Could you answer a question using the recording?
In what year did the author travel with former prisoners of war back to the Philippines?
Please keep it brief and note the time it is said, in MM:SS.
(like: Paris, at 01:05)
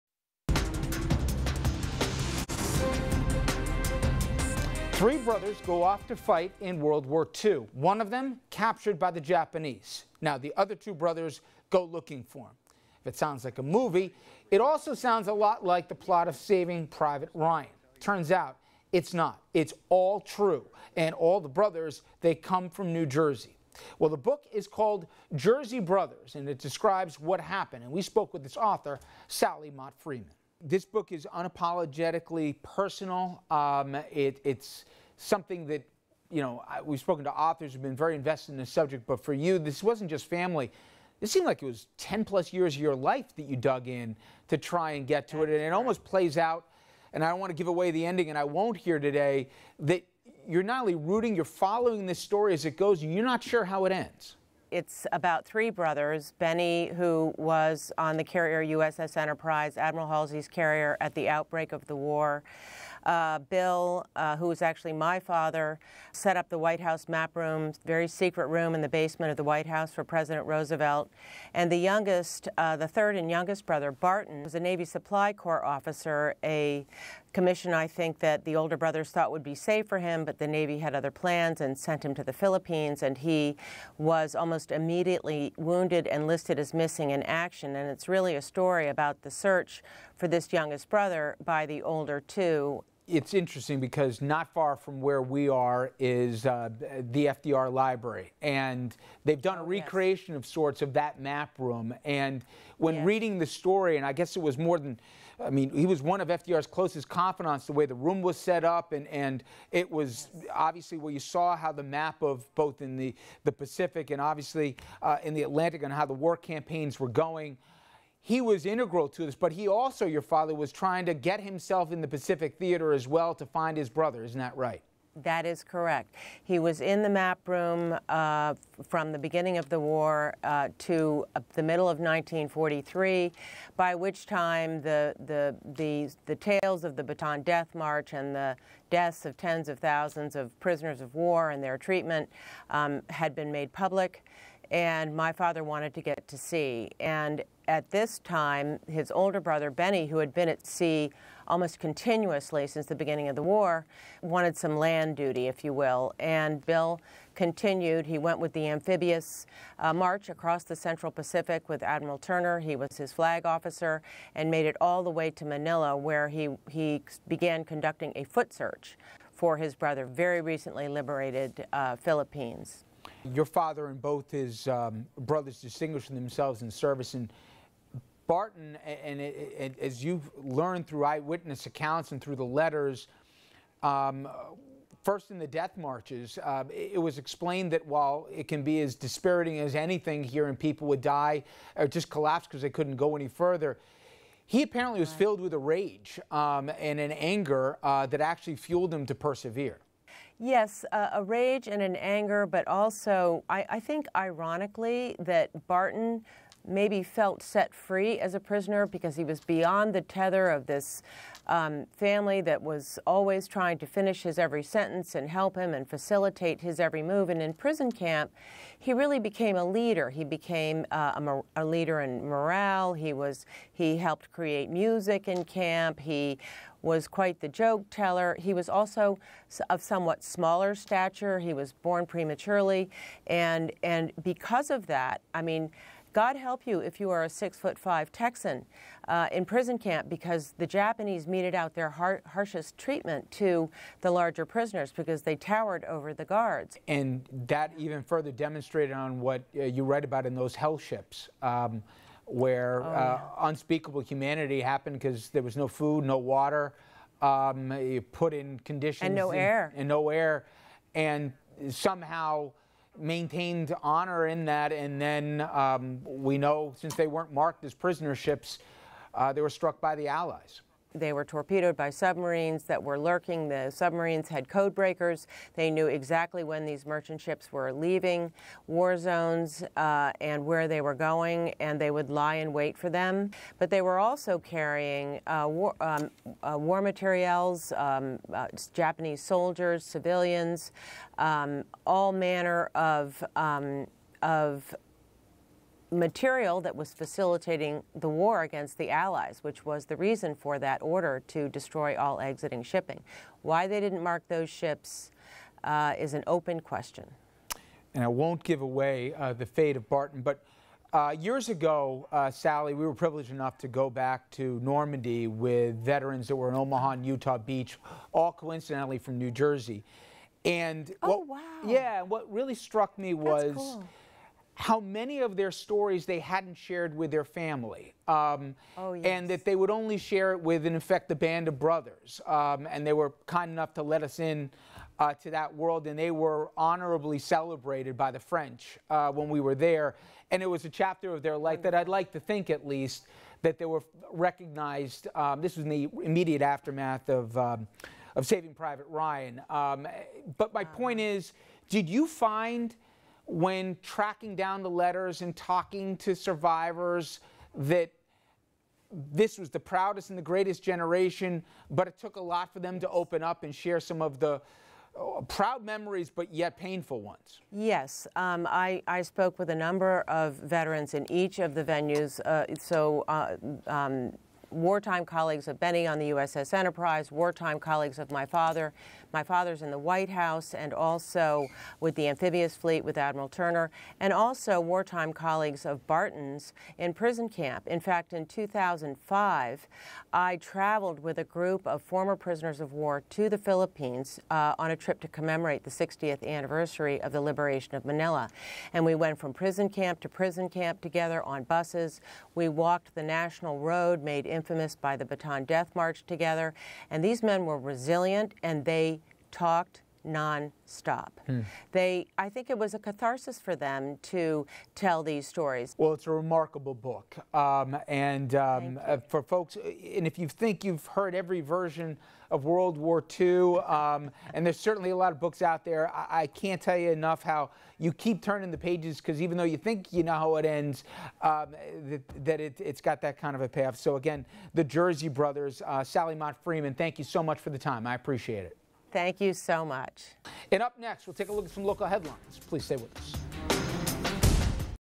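2005, at 06:28.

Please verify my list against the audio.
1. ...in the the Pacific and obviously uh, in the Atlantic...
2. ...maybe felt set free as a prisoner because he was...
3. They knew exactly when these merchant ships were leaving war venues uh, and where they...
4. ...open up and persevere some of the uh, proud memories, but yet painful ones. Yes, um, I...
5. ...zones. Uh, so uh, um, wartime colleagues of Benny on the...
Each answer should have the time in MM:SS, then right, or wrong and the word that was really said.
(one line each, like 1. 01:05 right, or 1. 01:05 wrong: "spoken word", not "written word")
1. 01:52 right
2. 03:26 right
3. 04:35 wrong: "zones", not "venues"
4. 06:02 wrong: "share", not "persevere"
5. 06:11 wrong: "venues", not "zones".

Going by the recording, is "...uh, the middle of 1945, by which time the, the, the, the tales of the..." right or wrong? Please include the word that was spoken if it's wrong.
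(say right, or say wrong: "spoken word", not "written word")
wrong: "1943", not "1945".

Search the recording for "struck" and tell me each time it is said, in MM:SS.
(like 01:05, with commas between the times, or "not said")
04:29, 05:22.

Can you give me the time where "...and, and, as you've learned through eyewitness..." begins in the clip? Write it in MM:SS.
02:59.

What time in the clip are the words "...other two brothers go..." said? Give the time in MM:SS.
00:10.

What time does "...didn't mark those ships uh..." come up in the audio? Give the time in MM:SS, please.
05:03.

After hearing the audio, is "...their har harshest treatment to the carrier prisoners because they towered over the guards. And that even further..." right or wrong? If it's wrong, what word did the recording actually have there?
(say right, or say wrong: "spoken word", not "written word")
wrong: "larger", not "carrier".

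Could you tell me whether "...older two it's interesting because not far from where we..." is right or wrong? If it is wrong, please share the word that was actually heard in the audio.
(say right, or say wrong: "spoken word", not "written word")
right.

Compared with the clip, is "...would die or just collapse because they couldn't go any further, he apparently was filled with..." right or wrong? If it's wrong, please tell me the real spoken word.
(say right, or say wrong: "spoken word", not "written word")
right.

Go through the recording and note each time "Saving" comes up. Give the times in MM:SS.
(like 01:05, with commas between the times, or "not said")
00:16, 05:48.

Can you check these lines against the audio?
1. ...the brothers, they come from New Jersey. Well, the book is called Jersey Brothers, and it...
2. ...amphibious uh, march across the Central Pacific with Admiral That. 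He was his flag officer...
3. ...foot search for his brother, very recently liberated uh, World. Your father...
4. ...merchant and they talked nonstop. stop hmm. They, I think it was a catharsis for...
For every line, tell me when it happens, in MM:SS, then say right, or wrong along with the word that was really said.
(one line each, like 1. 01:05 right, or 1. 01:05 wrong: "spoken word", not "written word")
1. 00:21 right
2. 02:38 wrong: "Turner", not "That"
3. 02:48 wrong: "Philippines", not "World"
4. 06:47 wrong: "resilient", not "merchant".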